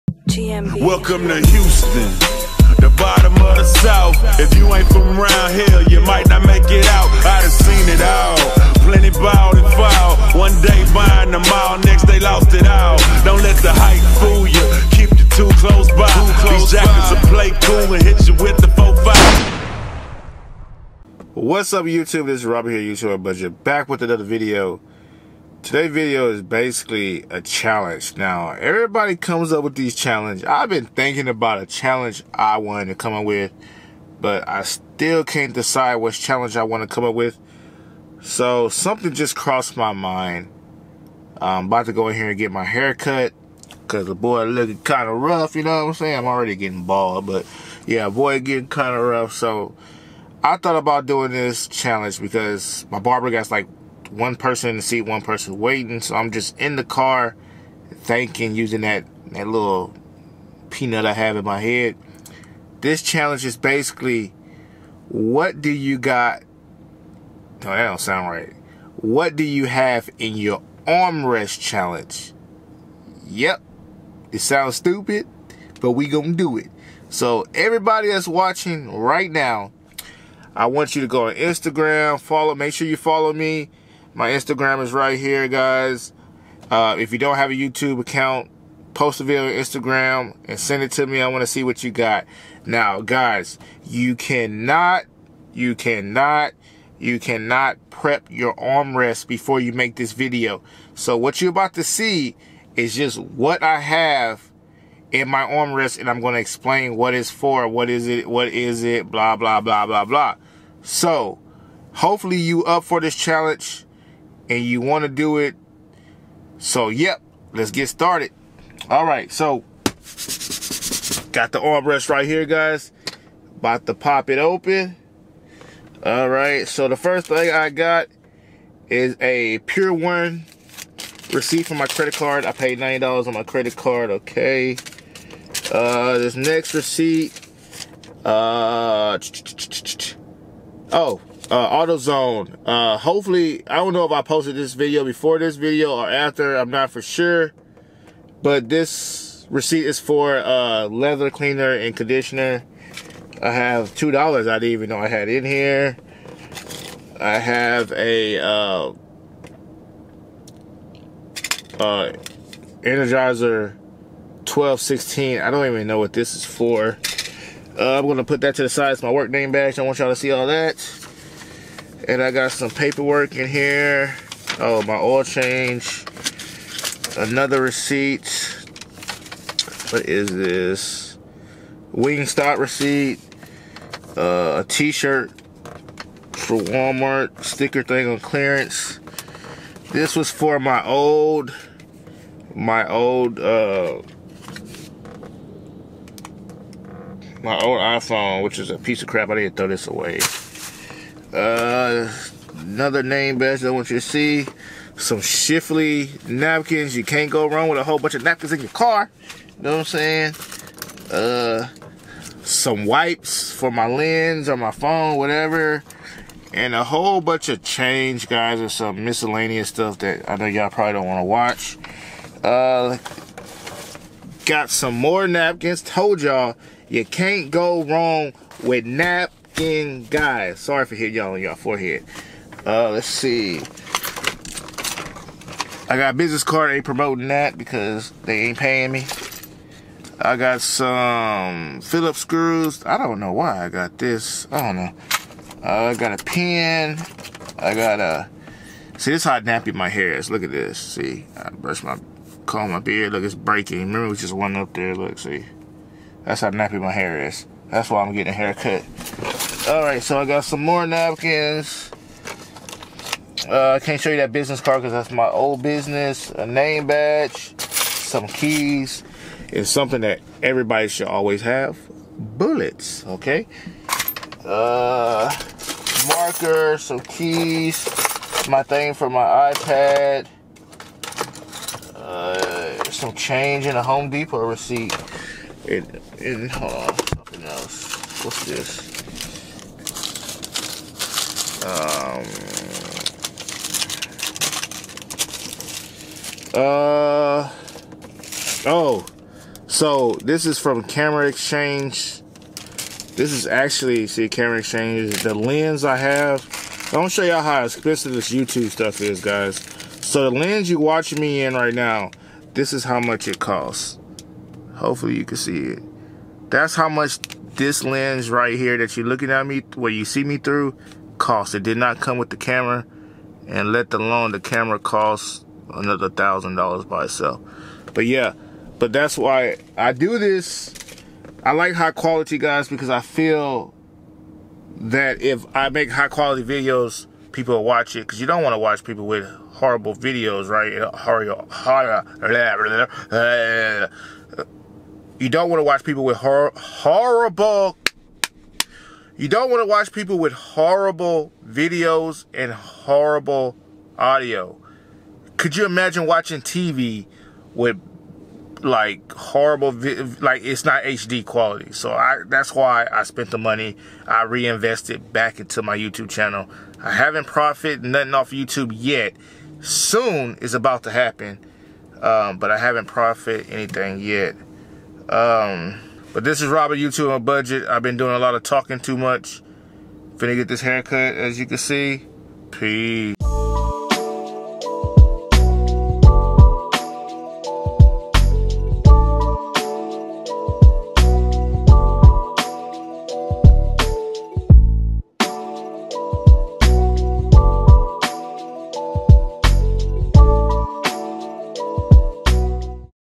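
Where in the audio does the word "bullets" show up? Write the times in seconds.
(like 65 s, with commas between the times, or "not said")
272 s.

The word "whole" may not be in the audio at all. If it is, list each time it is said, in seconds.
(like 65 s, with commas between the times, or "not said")
207 s, 216 s.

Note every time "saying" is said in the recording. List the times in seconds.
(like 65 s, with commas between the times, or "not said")
45 s, 209 s.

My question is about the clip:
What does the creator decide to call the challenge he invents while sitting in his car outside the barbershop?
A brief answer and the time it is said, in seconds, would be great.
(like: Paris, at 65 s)
What do you have in your armrest challenge, at 68 s.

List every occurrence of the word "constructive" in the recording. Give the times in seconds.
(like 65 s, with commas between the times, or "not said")
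not said.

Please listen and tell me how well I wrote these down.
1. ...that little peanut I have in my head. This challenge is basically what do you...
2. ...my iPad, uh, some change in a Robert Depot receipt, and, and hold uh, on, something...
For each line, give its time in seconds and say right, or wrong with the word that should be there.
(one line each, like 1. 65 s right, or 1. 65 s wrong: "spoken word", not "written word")
1. 59 s right
2. 279 s wrong: "Home", not "Robert".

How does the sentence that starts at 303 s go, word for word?
This is actually, see, Camera Exchange the lens I have.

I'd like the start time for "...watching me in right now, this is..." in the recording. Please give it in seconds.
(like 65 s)
310 s.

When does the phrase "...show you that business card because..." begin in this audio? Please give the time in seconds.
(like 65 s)
264 s.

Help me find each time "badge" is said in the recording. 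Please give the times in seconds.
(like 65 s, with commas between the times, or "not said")
169 s, 203 s, 266 s.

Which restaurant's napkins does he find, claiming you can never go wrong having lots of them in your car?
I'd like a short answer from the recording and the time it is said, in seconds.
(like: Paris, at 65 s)
Chick-fil-A, at 205 s.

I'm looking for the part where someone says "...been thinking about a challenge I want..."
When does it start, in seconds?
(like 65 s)
30 s.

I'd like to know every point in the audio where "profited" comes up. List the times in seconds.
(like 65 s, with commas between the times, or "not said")
367 s, 372 s.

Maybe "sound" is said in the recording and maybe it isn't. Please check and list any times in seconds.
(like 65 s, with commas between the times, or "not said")
67 s, 74 s.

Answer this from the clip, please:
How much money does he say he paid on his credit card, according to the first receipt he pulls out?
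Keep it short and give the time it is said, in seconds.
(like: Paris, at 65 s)
$90, at 132 s.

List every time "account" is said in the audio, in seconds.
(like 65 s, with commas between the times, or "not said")
88 s.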